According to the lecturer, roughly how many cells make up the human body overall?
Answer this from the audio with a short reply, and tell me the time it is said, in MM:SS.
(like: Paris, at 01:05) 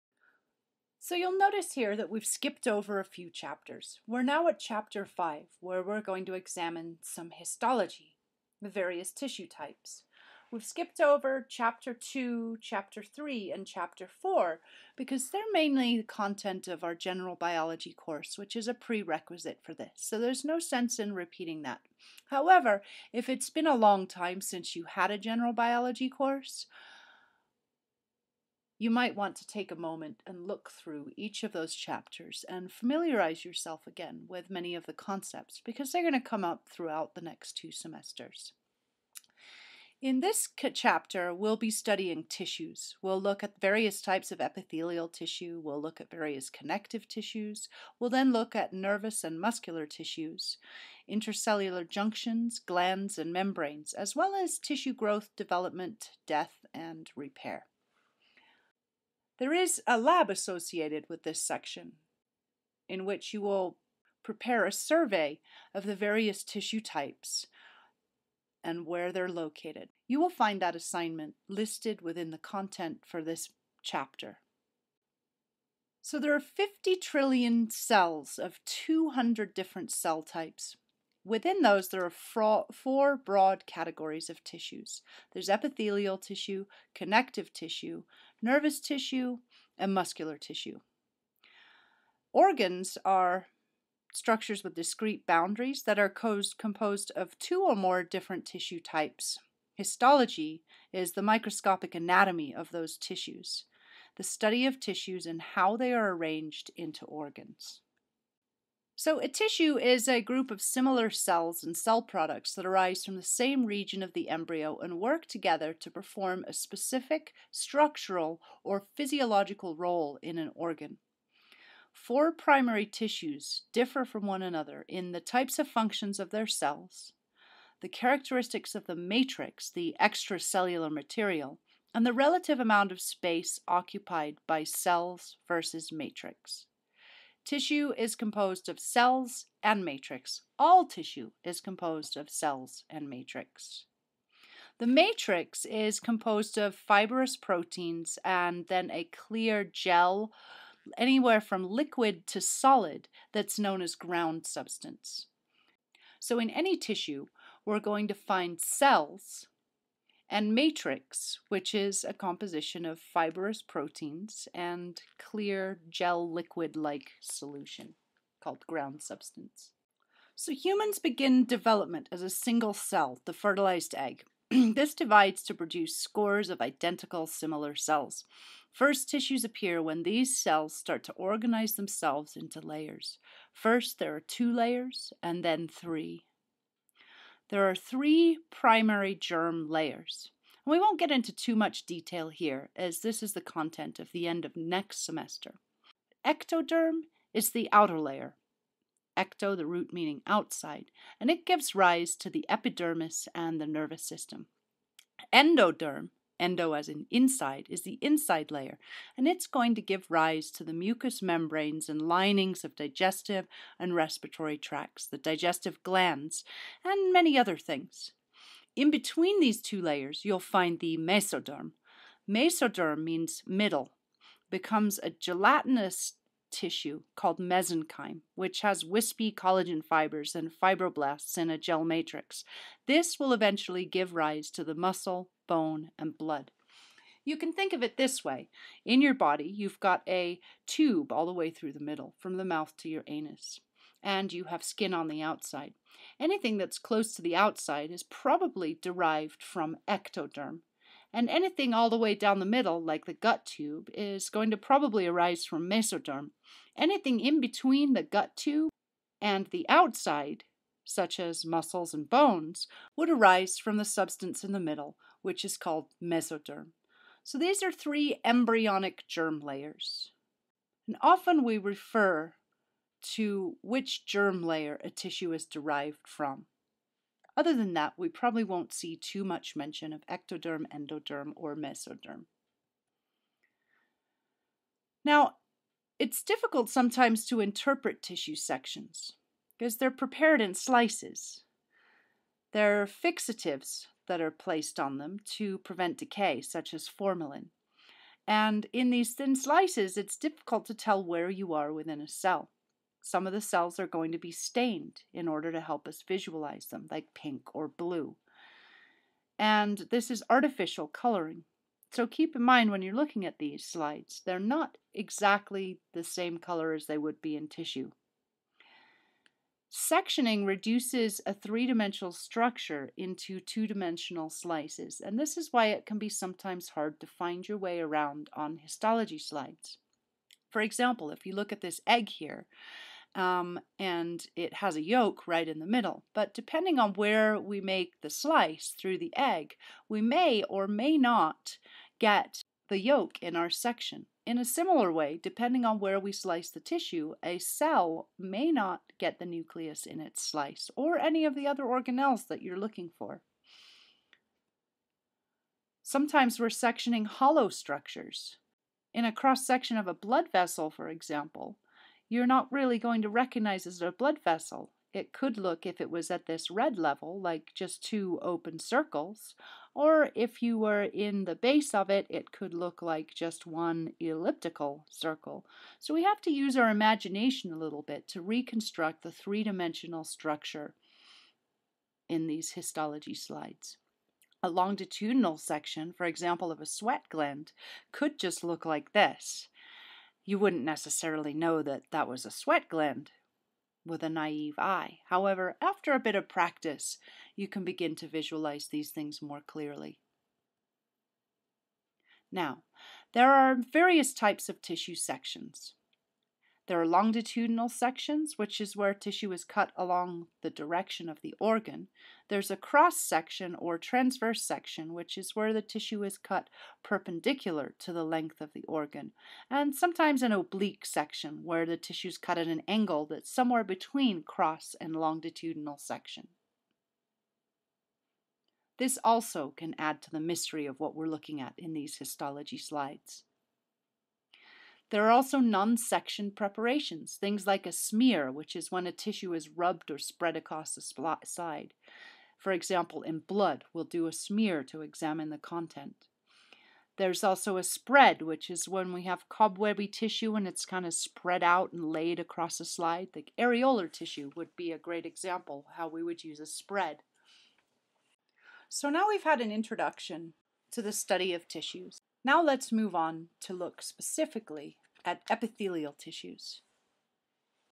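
50 trillion, at 01:16.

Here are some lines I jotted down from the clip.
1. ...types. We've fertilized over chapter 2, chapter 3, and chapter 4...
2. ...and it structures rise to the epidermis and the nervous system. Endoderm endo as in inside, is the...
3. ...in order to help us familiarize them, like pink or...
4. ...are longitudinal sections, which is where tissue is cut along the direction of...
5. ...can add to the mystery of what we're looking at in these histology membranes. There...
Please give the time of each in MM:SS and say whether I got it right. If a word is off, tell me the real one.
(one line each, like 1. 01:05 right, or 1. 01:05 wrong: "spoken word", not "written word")
1. 00:09 wrong: "skipped", not "fertilized"
2. 03:21 wrong: "gives", not "structures"
3. 05:05 wrong: "visualize", not "familiarize"
4. 06:46 right
5. 07:09 wrong: "slides", not "membranes".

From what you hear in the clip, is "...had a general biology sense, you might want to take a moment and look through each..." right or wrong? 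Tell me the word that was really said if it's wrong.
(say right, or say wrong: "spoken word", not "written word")
wrong: "course", not "sense".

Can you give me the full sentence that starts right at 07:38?
So now we've had an introduction to the study of tissues.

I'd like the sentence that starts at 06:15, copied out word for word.
So we have to use our imagination a little bit to reconstruct the three dimensional structure in these histology slides.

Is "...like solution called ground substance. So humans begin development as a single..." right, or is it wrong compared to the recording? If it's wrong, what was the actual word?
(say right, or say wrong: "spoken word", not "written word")
right.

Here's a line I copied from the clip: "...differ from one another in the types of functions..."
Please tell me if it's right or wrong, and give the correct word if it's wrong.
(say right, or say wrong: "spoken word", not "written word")
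right.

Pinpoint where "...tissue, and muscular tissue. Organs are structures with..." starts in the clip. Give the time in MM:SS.
01:28.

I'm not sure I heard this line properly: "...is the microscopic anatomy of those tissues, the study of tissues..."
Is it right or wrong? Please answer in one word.
right.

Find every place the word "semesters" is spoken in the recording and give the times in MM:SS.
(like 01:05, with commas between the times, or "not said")
00:37, 03:15.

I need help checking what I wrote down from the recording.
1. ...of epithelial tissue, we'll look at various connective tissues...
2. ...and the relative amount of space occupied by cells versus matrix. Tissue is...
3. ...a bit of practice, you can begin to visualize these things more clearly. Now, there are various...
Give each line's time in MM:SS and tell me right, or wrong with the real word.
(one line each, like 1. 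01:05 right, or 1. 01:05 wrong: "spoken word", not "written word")
1. 00:44 right
2. 02:11 right
3. 06:35 right.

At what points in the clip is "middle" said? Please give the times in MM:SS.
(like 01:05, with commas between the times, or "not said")
03:43, 04:01, 04:12, 04:24, 05:35.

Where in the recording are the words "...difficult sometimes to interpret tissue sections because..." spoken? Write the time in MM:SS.
04:46.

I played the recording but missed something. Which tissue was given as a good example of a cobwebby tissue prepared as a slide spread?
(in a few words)
areolar tissue.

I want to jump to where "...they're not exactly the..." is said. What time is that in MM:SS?
05:14.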